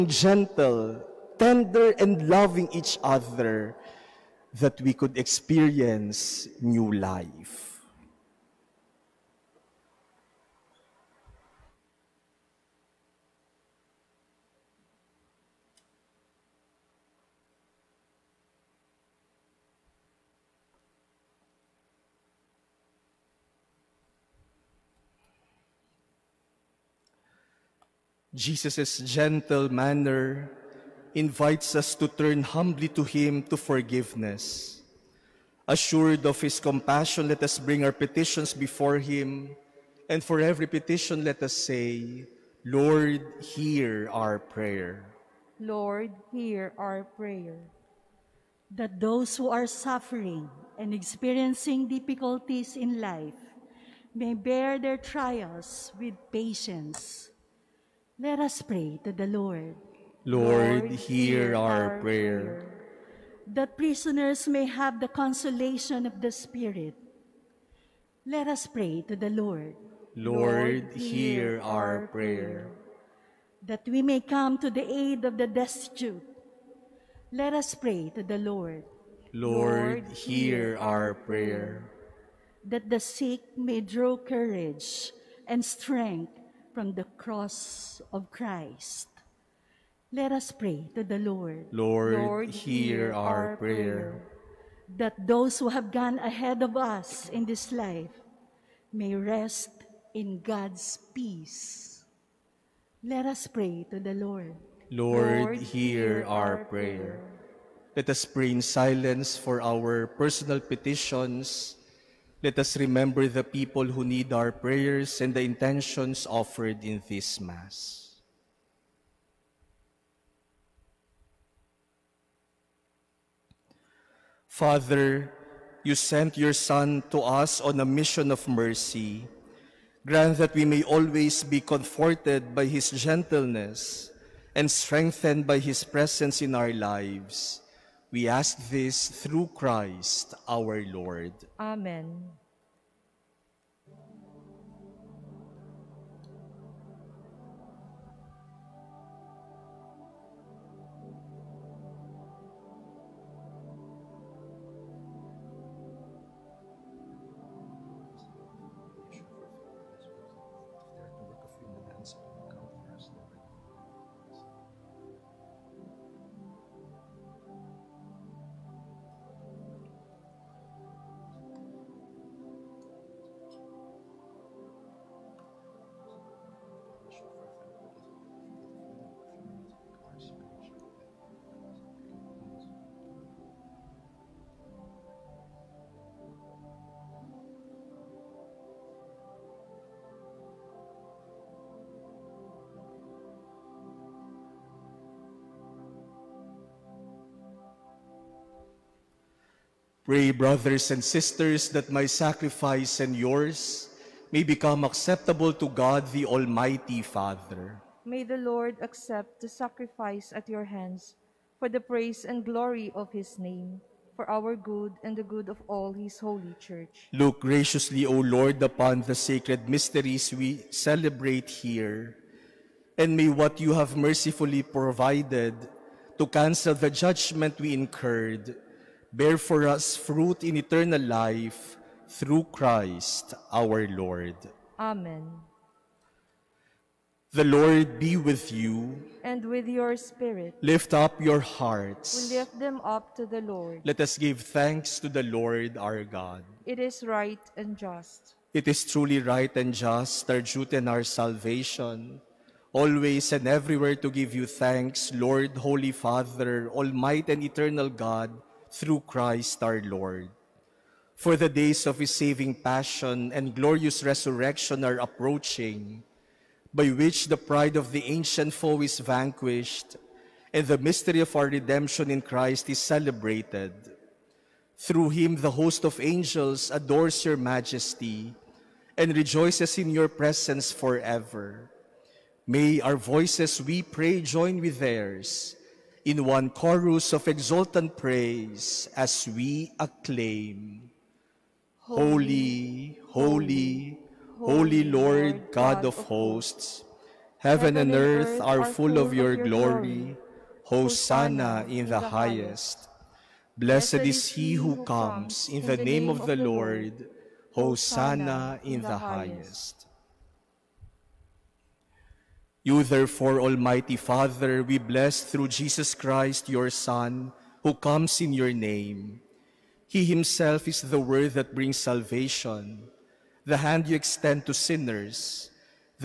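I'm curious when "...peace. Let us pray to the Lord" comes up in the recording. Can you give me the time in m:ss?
1:41.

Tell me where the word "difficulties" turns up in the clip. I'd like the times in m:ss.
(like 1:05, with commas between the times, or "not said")
0:51.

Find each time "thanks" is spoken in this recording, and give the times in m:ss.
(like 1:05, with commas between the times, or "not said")
4:04, 4:14.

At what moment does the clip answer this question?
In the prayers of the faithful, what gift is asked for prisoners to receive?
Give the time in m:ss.
1:05.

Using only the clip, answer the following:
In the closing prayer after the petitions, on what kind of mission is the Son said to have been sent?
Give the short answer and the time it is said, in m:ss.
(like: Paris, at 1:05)
A mission of mercy, at 2:07.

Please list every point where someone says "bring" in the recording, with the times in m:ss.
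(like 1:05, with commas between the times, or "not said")
0:37, 5:21.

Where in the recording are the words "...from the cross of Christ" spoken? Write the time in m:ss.
1:26.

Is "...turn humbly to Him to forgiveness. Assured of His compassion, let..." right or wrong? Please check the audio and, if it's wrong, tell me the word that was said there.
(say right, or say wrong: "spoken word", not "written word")
right.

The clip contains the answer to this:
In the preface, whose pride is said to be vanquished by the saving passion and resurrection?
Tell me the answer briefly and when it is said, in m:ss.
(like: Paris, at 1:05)
The ancient foe, at 4:27.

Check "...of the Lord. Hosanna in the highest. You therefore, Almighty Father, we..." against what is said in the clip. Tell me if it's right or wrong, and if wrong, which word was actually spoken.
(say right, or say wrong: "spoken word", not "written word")
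right.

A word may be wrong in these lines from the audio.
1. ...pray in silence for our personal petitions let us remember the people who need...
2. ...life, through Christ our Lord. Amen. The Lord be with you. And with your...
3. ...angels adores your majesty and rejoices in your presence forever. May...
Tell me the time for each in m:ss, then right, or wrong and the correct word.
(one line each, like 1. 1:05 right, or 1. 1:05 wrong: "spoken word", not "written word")
1. 1:48 right
2. 3:51 right
3. 4:35 right.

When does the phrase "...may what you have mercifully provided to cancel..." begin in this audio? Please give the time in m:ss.
3:43.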